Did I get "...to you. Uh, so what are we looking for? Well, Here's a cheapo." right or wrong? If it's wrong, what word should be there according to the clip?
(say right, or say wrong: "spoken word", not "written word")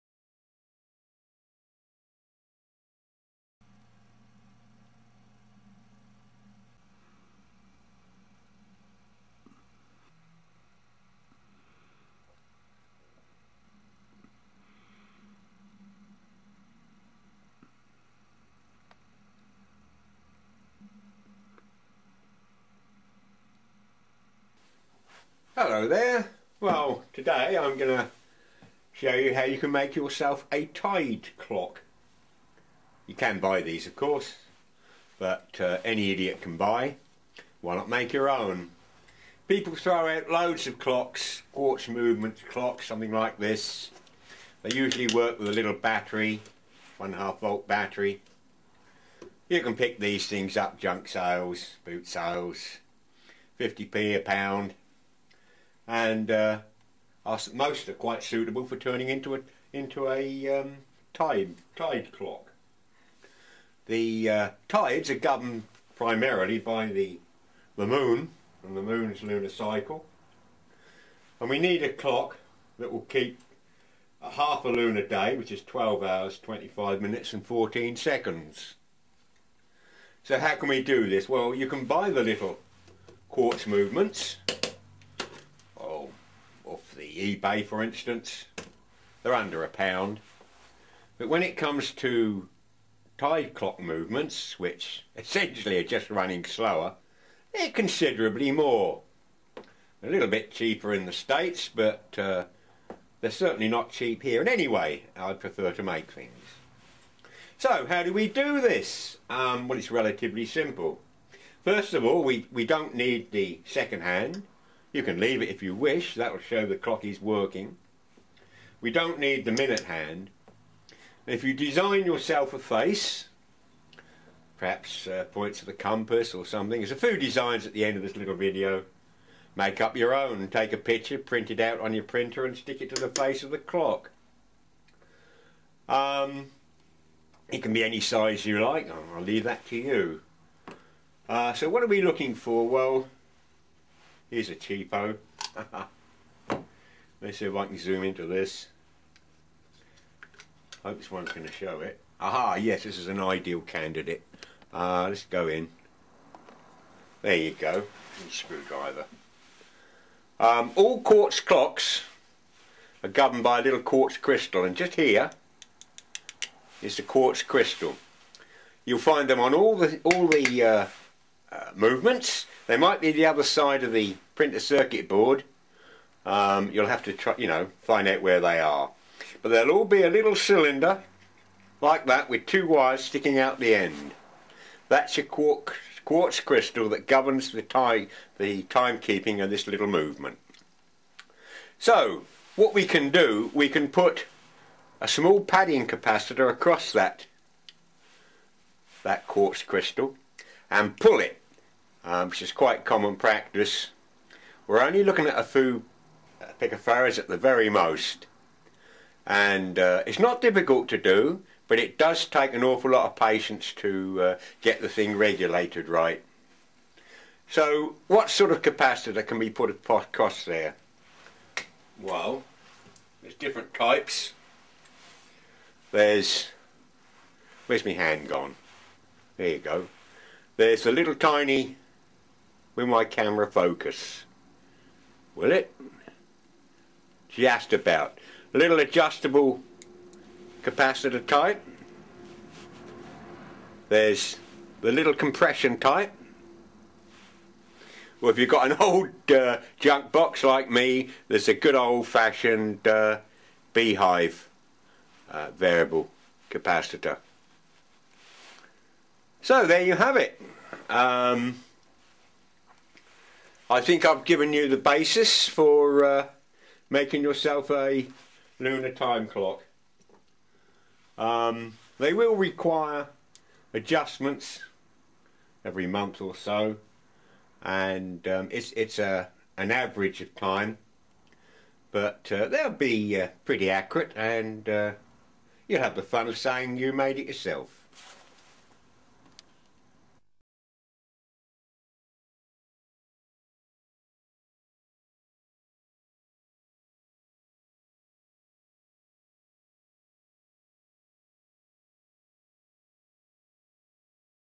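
right.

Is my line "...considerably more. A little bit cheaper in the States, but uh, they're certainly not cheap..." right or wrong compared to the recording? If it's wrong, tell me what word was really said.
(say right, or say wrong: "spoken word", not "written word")
right.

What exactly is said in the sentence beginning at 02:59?
But they will all be a little cylinder like that with two wires sticking out the end.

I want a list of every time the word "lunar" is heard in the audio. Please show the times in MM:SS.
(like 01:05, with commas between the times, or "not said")
01:09, 01:14, 04:28.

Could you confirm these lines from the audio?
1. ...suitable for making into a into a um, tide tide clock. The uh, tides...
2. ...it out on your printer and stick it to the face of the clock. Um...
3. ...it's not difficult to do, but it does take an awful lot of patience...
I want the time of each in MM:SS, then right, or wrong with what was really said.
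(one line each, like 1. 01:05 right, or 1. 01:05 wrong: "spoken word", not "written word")
1. 00:58 wrong: "turning", not "making"
2. 02:11 right
3. 03:30 right.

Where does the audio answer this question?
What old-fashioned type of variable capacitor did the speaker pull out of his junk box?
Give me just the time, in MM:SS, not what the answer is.
04:13.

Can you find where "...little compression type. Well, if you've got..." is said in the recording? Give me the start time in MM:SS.
04:04.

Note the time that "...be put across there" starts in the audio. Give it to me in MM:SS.
03:39.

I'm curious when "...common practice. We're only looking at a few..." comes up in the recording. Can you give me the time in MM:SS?
03:22.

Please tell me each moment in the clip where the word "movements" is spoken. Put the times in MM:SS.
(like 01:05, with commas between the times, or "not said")
00:41, 01:23, 01:33, 02:51, 03:09.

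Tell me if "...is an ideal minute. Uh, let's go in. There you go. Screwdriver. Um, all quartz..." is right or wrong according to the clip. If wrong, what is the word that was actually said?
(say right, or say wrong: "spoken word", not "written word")
wrong: "candidate", not "minute".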